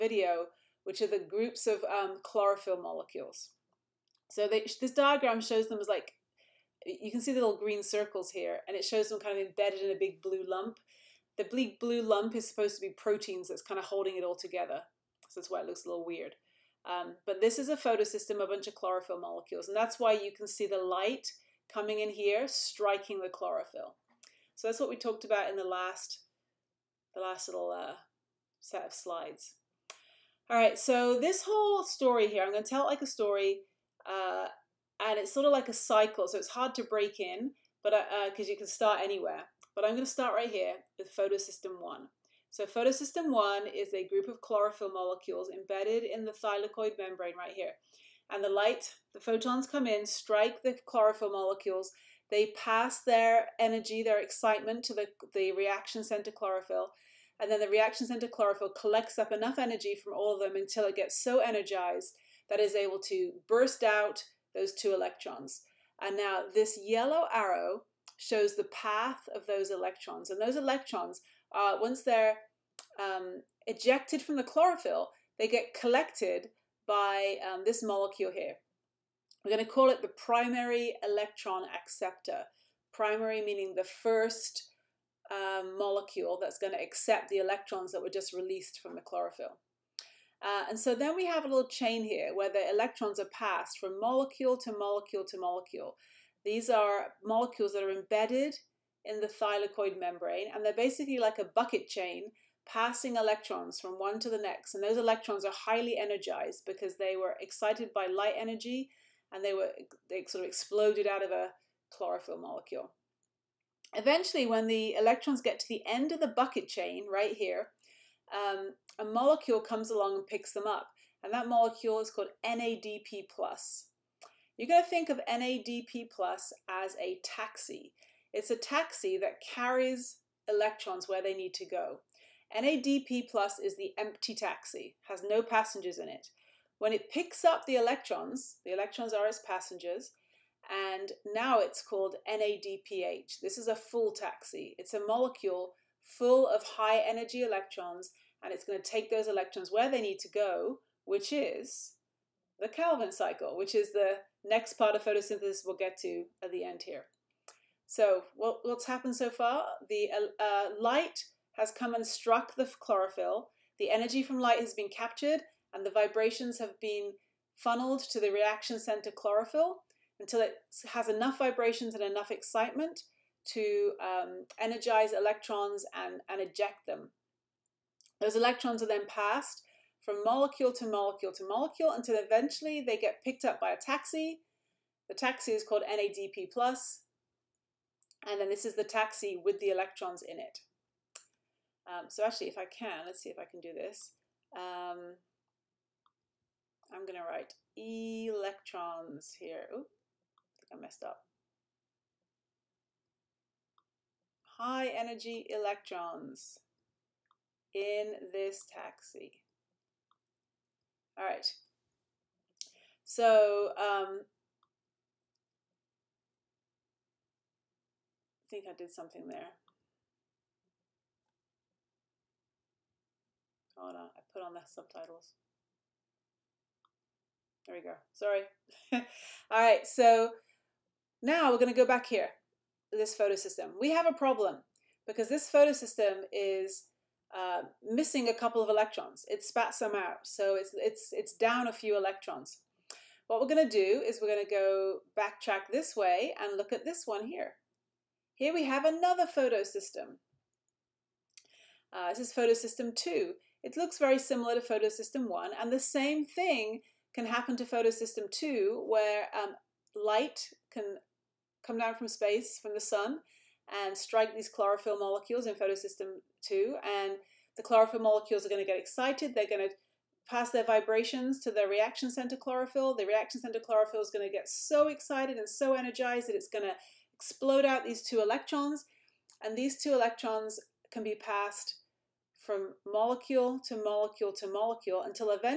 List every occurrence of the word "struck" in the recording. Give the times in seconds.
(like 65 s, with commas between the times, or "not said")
162 s.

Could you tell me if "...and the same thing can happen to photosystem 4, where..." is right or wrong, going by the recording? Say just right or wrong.
wrong.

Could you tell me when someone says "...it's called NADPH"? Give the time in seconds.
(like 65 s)
141 s.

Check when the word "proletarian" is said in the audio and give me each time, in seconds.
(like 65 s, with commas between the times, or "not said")
not said.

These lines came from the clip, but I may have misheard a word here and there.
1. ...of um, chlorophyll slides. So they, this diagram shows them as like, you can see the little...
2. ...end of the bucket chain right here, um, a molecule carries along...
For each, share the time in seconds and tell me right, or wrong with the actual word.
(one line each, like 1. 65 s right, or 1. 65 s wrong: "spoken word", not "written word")
1. 1 s wrong: "molecules", not "slides"
2. 115 s wrong: "comes", not "carries".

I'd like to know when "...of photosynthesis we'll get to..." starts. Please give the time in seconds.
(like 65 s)
154 s.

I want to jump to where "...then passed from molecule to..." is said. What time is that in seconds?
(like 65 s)
178 s.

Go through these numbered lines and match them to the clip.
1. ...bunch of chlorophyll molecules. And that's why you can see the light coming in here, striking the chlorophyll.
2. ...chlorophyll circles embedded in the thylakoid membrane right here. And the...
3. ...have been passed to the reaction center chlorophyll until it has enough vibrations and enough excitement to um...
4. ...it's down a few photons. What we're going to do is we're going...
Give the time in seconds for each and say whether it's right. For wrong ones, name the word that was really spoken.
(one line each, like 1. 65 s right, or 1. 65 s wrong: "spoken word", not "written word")
1. 18 s right
2. 44 s wrong: "molecules", not "circles"
3. 166 s wrong: "funneled", not "passed"
4. 241 s wrong: "electrons", not "photons".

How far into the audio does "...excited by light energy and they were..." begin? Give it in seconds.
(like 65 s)
107 s.